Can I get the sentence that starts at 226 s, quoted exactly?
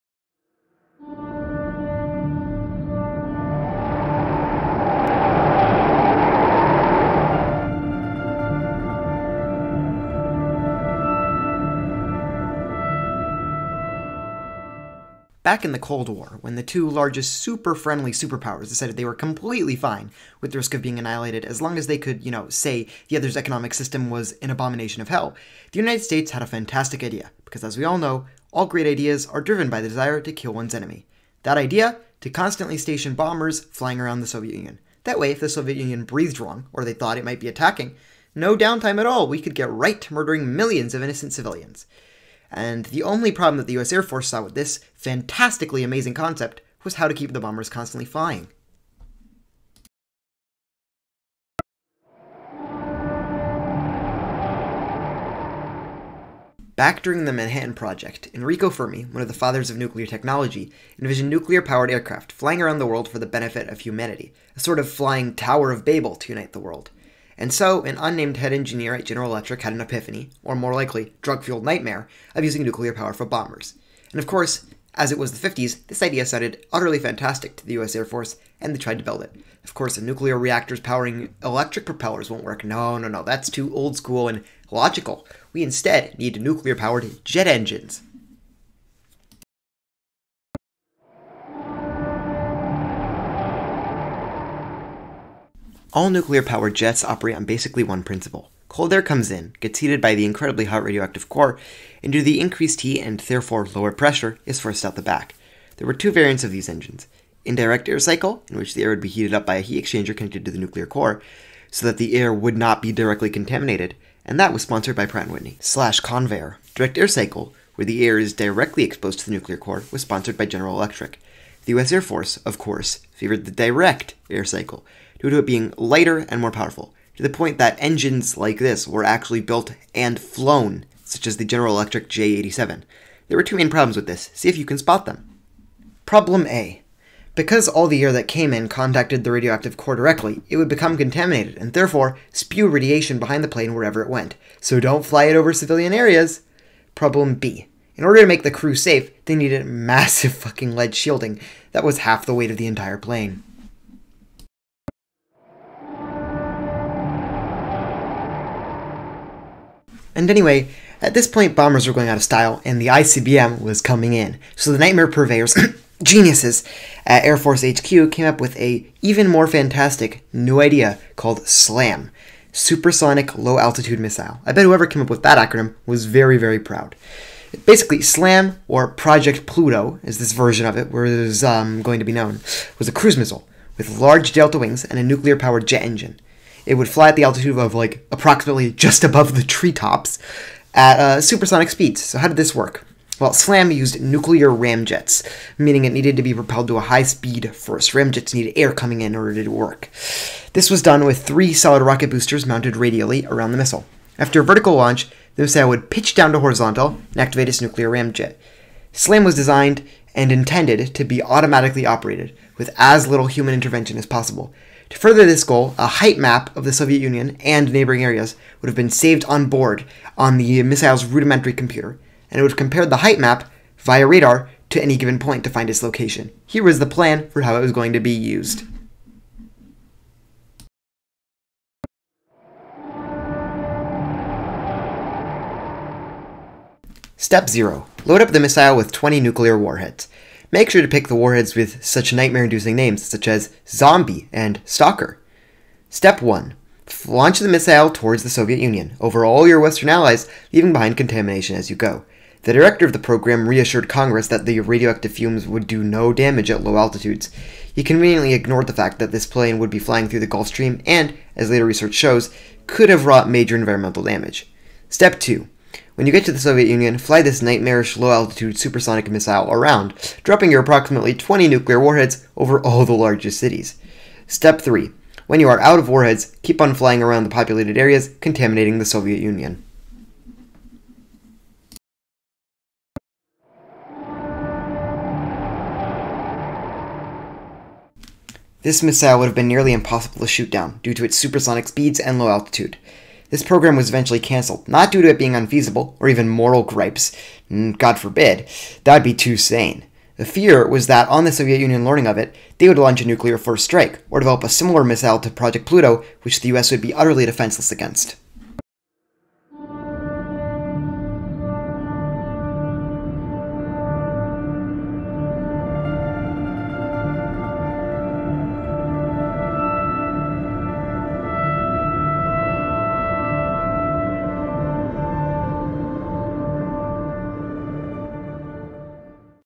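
Here was the plan for how it was going to be used.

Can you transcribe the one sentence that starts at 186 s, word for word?
It would fly at the altitude of like approximately just above the treetops at uh, supersonic speeds.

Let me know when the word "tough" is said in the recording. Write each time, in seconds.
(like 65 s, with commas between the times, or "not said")
not said.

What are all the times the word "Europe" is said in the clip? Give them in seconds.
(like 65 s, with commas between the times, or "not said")
not said.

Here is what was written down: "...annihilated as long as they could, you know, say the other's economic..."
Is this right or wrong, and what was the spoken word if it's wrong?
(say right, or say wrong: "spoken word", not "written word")
right.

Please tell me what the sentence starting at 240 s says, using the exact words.
Make sure to pick the warheads with such nightmare-inducing names such as Zombie and Stalker.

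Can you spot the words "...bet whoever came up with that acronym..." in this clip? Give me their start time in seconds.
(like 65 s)
174 s.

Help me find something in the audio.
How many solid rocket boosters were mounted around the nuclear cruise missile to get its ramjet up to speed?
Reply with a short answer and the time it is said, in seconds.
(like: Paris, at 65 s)
3, at 201 s.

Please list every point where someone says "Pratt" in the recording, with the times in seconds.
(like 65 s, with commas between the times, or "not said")
115 s.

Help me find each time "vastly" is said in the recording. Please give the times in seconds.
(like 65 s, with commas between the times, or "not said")
not said.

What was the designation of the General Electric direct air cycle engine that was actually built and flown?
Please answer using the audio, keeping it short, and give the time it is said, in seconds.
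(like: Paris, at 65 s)
J87, at 132 s.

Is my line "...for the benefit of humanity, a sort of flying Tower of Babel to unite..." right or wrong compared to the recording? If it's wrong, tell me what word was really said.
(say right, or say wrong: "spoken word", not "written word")
right.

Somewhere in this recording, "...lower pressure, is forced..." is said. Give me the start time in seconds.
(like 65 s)
103 s.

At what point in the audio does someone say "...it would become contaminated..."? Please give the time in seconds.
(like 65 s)
140 s.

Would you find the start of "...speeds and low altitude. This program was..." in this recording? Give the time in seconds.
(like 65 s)
291 s.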